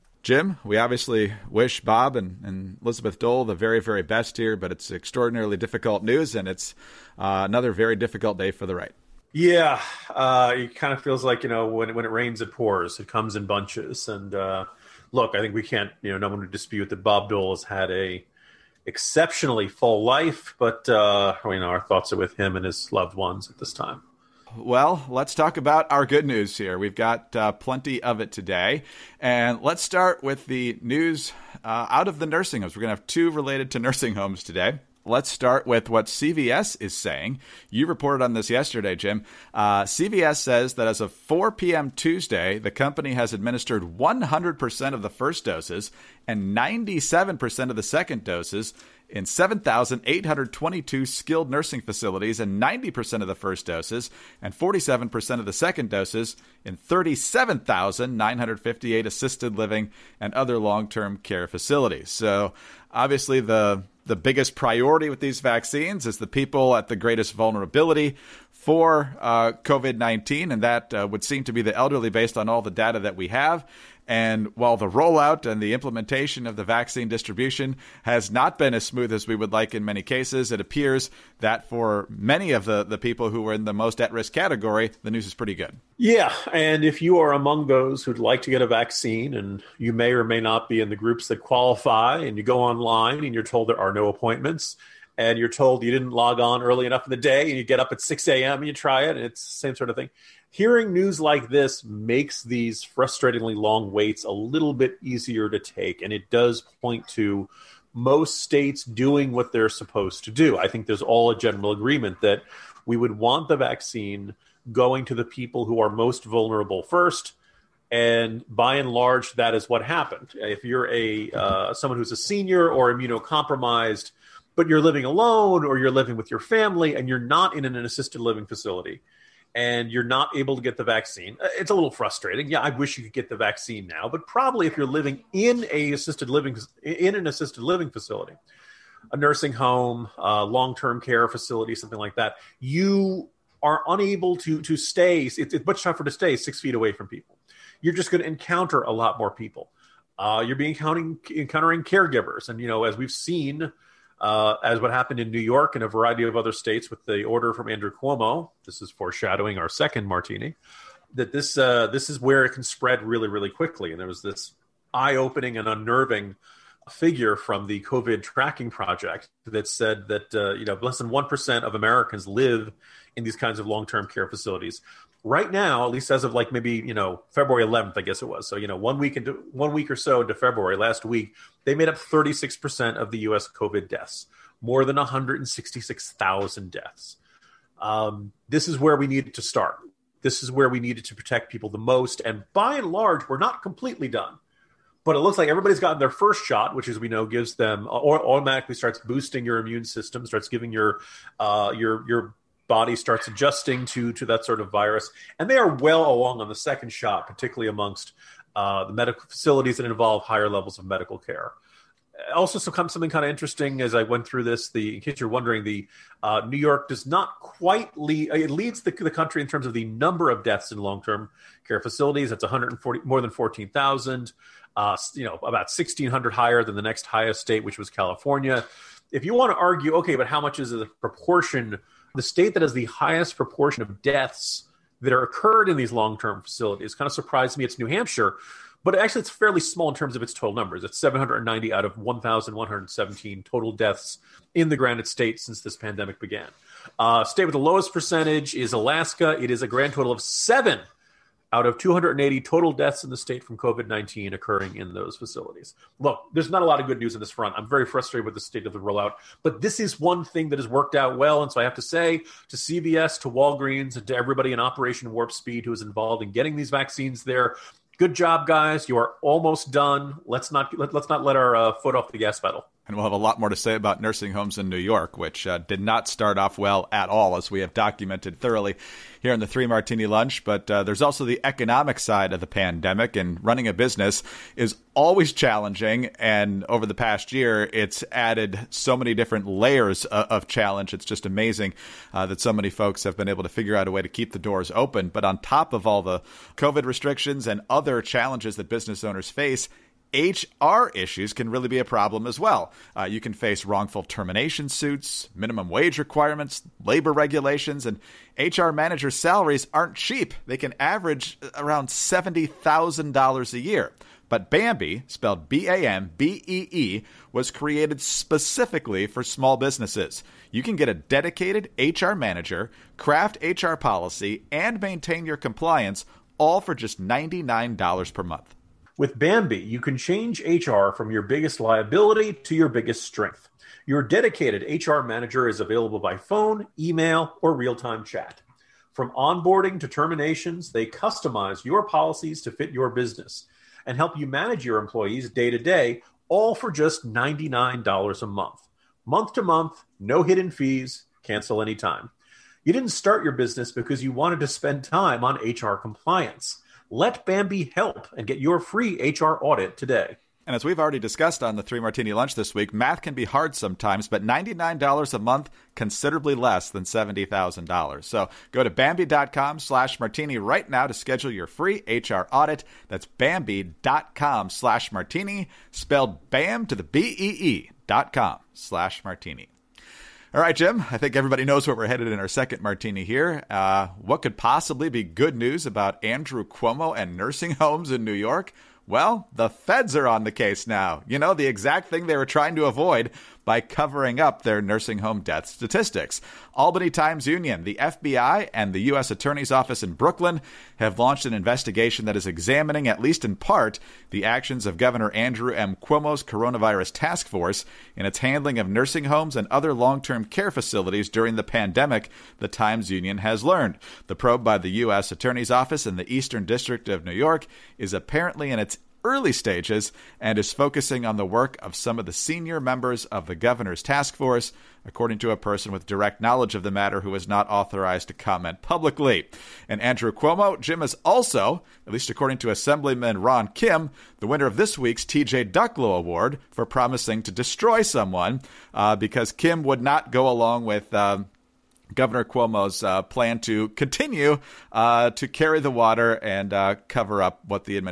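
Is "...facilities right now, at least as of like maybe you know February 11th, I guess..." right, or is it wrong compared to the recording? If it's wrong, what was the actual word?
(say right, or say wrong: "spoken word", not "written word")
right.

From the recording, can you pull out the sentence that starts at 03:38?
Uh, it leads the, the country in terms of the number of deaths in long-term care facilities.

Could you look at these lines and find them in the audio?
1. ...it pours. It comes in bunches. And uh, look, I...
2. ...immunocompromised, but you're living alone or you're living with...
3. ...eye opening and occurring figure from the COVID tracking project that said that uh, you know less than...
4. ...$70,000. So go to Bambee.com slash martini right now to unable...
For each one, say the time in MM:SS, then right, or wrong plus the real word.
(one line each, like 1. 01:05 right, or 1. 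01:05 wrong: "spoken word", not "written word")
1. 00:12 right
2. 02:02 right
3. 02:44 wrong: "unnerving", not "occurring"
4. 06:06 wrong: "schedule", not "unable".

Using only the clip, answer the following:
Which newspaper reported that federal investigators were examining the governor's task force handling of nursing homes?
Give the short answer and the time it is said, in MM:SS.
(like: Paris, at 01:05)
Albany Times Union, at 06:36.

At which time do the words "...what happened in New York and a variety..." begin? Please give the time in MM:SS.
02:34.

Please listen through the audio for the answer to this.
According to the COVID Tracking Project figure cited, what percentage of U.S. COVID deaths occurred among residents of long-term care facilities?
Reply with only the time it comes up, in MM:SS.
03:01.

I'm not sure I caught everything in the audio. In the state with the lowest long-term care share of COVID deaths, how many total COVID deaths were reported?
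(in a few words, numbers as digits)
280.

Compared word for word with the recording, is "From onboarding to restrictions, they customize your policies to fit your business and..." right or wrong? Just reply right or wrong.
wrong.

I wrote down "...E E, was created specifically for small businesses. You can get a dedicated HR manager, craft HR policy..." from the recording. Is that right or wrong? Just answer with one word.
right.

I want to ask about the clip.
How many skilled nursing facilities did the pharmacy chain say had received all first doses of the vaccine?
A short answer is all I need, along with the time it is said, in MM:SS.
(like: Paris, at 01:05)
7,822, at 00:49.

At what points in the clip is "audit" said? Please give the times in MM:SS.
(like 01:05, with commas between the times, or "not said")
05:59, 06:12.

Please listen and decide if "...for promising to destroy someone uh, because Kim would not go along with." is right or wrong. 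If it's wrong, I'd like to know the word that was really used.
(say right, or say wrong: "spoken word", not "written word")
right.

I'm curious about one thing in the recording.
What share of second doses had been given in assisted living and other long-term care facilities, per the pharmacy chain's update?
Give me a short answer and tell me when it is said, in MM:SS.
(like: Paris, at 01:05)
47%, at 00:54.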